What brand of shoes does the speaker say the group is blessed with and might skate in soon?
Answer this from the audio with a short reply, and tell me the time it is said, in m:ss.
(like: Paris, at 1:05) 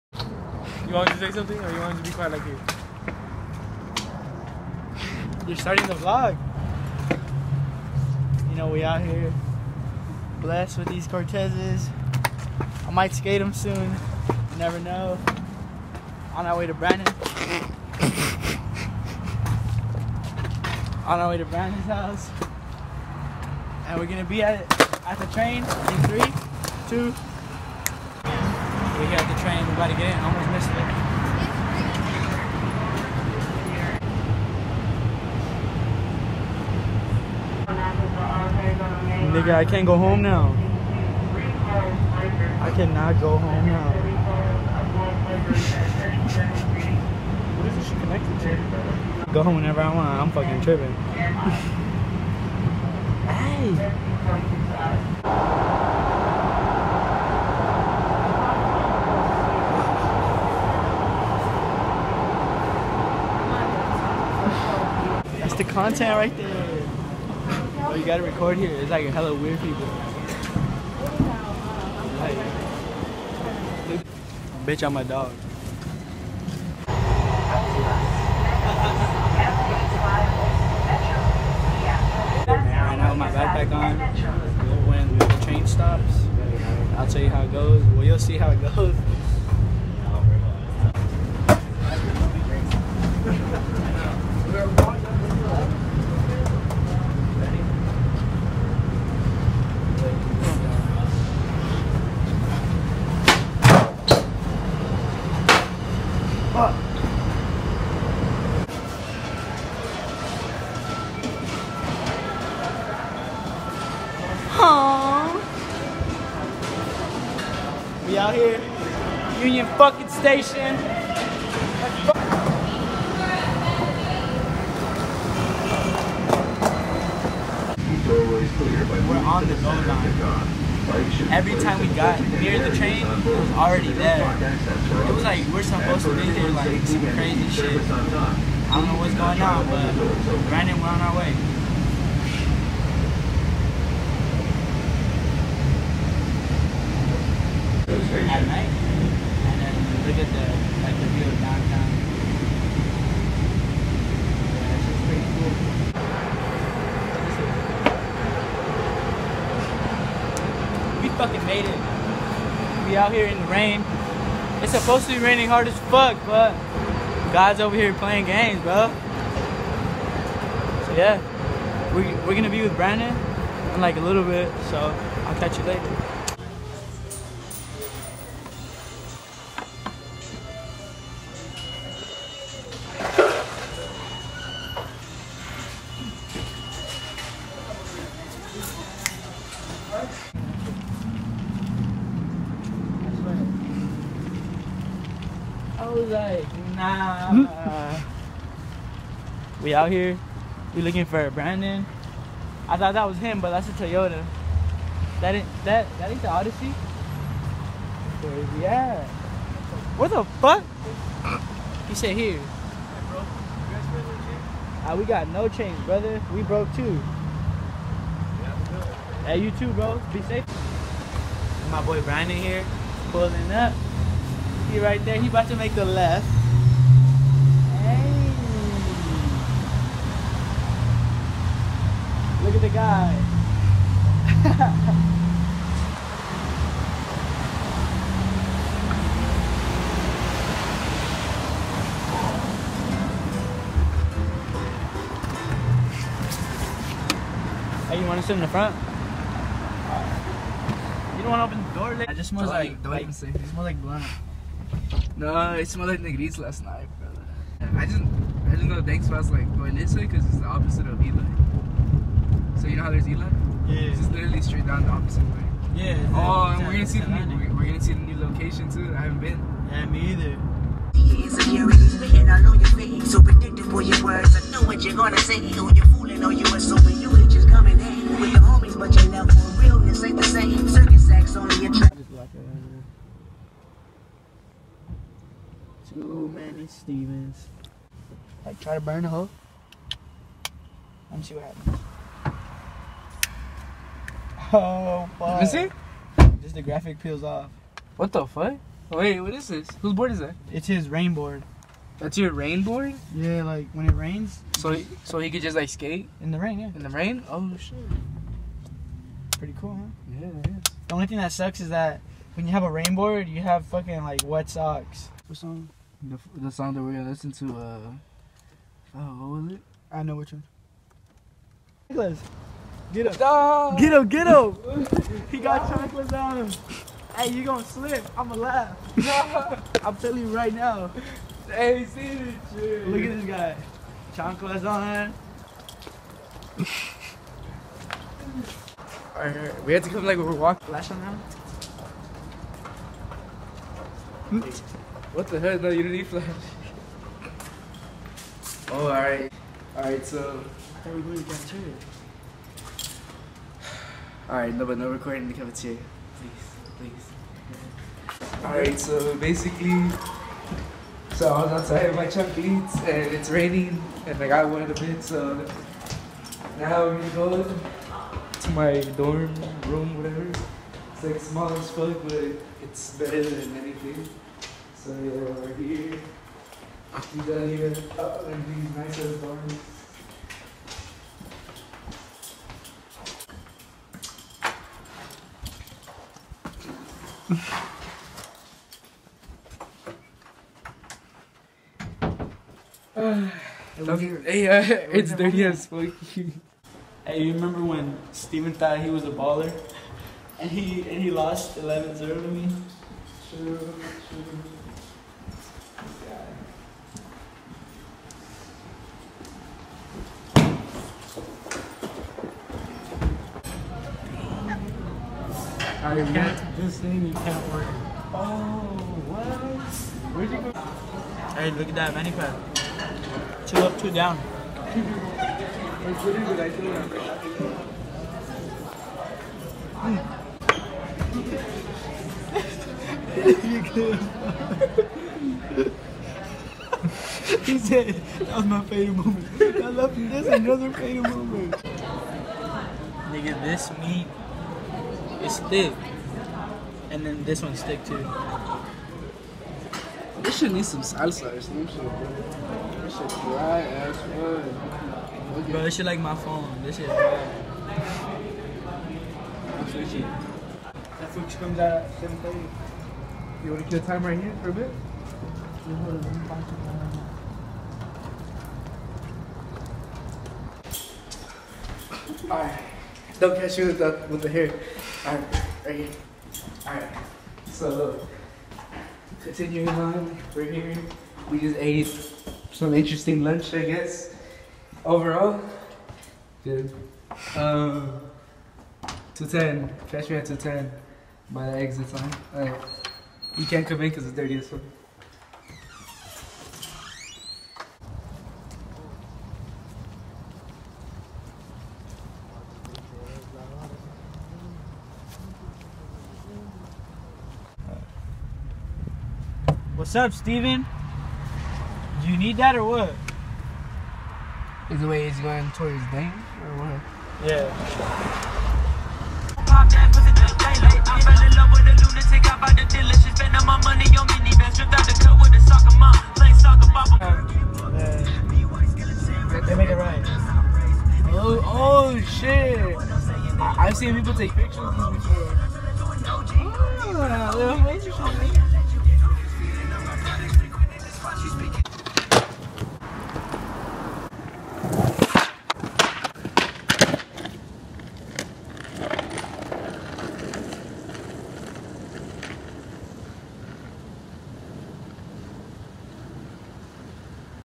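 Cortezes, at 0:11.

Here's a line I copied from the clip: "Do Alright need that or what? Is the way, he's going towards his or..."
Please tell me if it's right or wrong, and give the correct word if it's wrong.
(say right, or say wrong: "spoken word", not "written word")
wrong: "You", not "Alright".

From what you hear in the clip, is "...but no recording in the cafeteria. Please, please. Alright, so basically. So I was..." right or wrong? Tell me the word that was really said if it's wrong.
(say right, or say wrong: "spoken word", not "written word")
right.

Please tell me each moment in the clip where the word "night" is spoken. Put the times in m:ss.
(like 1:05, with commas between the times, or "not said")
2:28, 4:16.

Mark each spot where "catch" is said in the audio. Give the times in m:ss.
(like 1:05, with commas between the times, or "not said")
2:55, 7:53, 8:09.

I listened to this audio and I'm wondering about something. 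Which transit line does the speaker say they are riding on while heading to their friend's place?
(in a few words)
Go line.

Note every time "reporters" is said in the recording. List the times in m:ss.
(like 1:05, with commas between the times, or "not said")
not said.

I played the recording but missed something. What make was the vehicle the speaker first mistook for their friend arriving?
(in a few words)
Toyota.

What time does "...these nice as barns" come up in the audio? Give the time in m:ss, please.
6:18.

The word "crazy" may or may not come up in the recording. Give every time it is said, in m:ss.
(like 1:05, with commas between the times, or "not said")
2:17.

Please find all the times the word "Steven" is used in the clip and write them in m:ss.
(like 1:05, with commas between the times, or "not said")
4:46, 6:38, 8:30.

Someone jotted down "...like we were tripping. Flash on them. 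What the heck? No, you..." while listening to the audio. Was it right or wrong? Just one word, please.
wrong.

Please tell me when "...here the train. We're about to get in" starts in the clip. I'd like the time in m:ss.
0:29.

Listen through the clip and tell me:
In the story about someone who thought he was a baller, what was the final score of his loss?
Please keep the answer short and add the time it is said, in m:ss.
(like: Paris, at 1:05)
11-0, at 6:41.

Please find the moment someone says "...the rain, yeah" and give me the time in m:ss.
5:06.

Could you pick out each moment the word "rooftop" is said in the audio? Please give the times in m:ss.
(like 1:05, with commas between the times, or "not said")
not said.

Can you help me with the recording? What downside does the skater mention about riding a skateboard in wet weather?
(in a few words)
wet socks.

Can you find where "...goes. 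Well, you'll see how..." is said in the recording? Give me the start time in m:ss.
1:27.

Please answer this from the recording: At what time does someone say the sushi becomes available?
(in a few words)
7:30.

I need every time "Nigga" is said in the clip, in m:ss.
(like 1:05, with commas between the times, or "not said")
0:39, 7:23.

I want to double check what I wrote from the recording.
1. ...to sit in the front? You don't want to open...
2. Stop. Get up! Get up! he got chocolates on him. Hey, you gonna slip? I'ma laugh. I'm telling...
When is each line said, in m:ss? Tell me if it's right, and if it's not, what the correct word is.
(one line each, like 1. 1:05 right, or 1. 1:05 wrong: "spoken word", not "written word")
1. 4:08 right
2. 5:23 right.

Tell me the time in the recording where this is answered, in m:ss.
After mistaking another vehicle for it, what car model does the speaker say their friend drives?
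3:26.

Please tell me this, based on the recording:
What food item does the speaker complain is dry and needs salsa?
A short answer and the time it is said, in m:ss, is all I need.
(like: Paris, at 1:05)
meat, at 7:23.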